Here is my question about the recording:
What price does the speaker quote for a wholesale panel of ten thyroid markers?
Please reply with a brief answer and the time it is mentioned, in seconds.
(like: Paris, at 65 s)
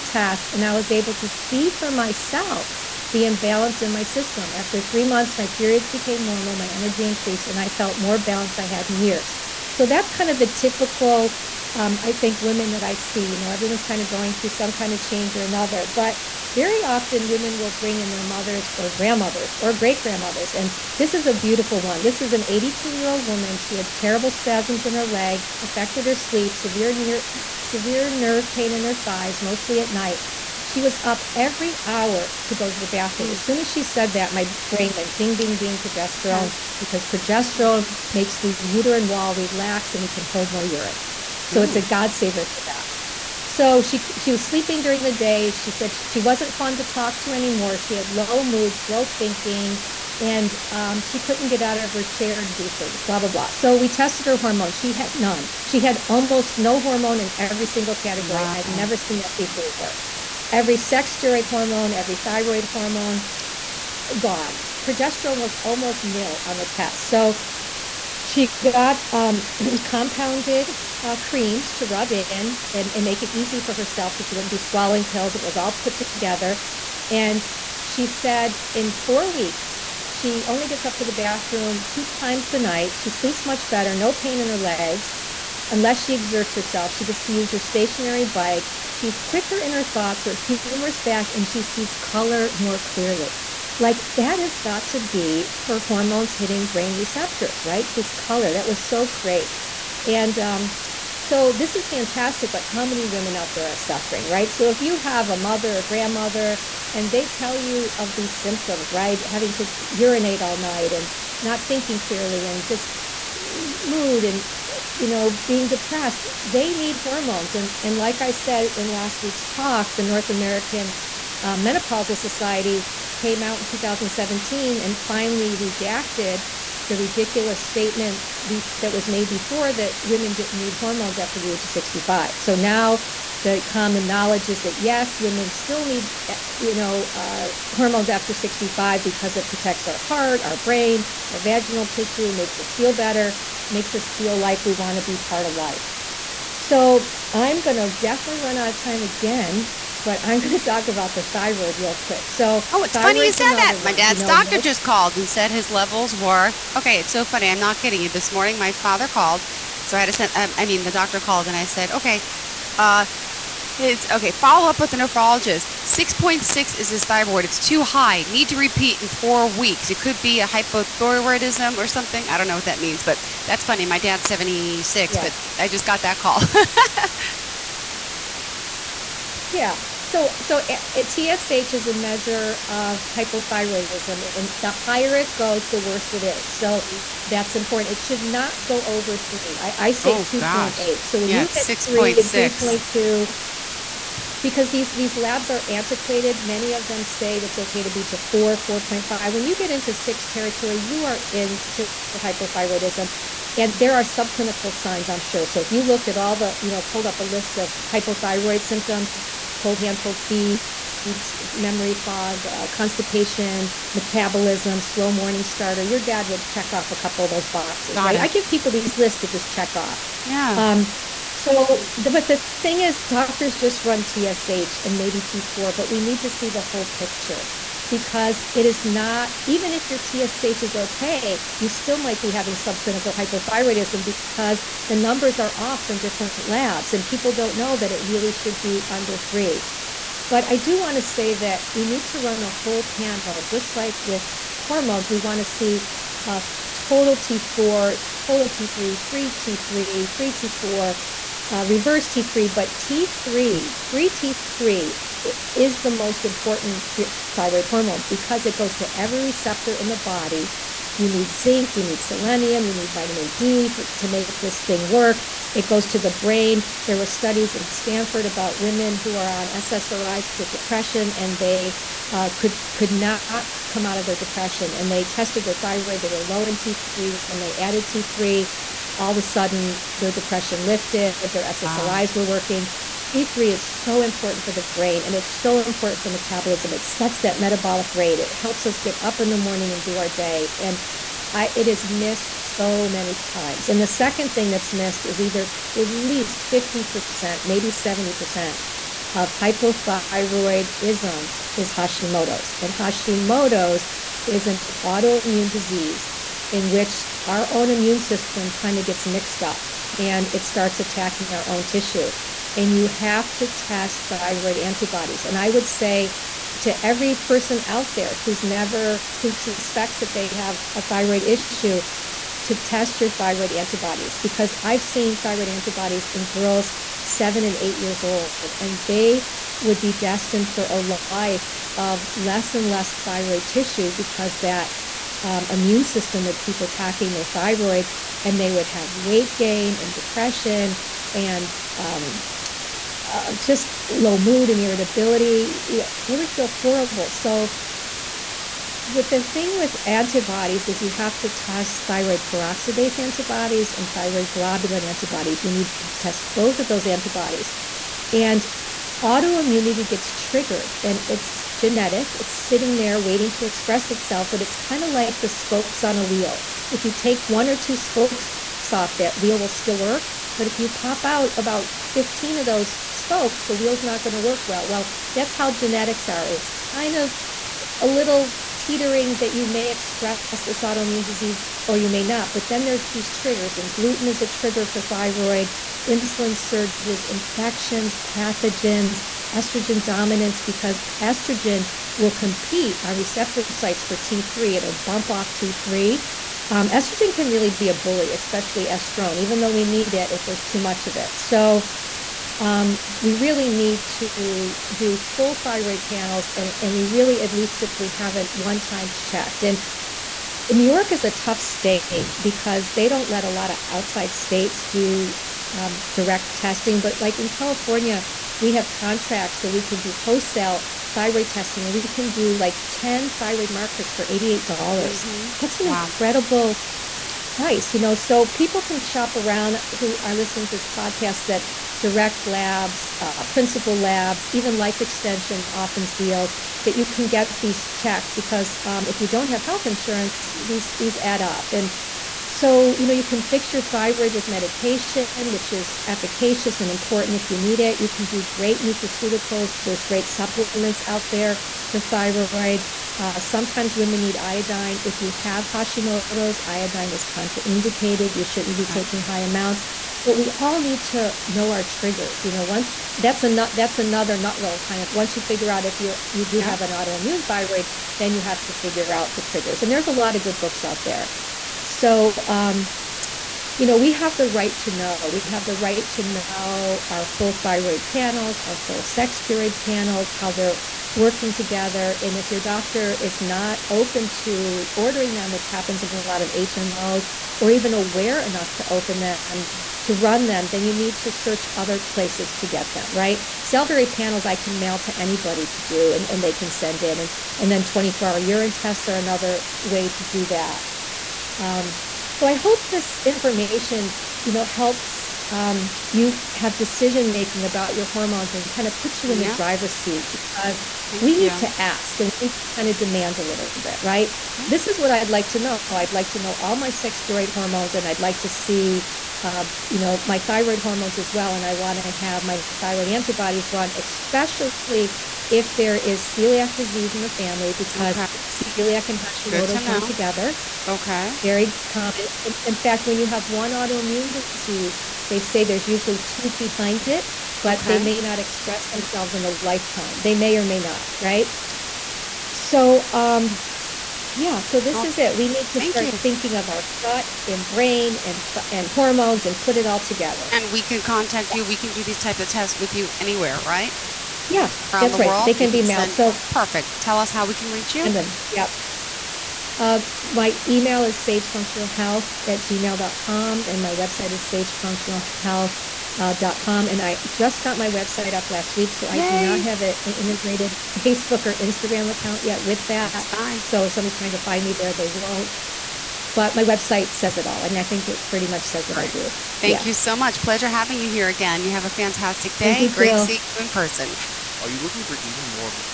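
$88, at 424 s.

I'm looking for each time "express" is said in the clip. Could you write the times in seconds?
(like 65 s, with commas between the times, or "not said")
363 s, 379 s, 538 s.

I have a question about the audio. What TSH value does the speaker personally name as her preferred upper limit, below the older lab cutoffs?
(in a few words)
2.8.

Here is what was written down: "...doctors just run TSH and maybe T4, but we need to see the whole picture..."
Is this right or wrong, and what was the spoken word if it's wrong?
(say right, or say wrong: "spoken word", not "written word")
right.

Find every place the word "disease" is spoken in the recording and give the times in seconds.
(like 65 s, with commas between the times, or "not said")
305 s, 381 s, 526 s, 534 s.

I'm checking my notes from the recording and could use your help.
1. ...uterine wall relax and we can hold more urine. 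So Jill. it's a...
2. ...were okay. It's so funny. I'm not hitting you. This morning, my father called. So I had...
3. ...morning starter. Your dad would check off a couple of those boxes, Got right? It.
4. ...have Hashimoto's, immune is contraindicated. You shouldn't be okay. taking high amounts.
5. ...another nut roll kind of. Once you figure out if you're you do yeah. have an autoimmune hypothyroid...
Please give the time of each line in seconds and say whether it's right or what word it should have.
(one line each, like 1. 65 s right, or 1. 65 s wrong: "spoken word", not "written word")
1. 38 s wrong: "Ooh", not "Jill"
2. 156 s wrong: "kidding", not "hitting"
3. 215 s right
4. 455 s wrong: "iodine", not "immune"
5. 463 s wrong: "thyroid", not "hypothyroid".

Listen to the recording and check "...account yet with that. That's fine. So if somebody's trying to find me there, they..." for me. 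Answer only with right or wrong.
right.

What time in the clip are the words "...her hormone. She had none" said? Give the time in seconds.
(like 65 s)
54 s.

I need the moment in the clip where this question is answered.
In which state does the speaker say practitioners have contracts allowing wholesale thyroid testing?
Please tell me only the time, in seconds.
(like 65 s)
417 s.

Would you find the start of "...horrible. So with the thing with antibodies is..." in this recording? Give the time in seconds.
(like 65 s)
346 s.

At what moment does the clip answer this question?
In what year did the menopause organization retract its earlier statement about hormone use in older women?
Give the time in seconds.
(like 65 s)
123 s.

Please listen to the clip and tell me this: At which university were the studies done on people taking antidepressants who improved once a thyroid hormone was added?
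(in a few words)
Stanford.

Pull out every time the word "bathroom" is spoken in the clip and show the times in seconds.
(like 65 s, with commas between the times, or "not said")
32 s, 81 s.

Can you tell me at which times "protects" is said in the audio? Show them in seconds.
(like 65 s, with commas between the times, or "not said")
139 s.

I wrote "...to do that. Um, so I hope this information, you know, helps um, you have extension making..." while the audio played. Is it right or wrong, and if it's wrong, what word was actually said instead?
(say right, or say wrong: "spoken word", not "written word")
wrong: "decision", not "extension".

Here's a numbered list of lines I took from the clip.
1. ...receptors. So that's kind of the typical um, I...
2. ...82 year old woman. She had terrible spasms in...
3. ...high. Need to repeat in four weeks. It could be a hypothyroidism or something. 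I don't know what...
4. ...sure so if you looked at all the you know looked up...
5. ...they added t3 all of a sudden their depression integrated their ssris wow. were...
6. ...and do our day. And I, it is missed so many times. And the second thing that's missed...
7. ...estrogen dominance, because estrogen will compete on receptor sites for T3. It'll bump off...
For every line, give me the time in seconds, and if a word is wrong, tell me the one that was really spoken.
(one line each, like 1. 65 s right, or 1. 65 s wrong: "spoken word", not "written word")
1. 8 s wrong: "years", not "receptors"
2. 22 s right
3. 167 s right
4. 205 s wrong: "pulled", not "looked"
5. 277 s wrong: "lifted", not "integrated"
6. 289 s right
7. 389 s right.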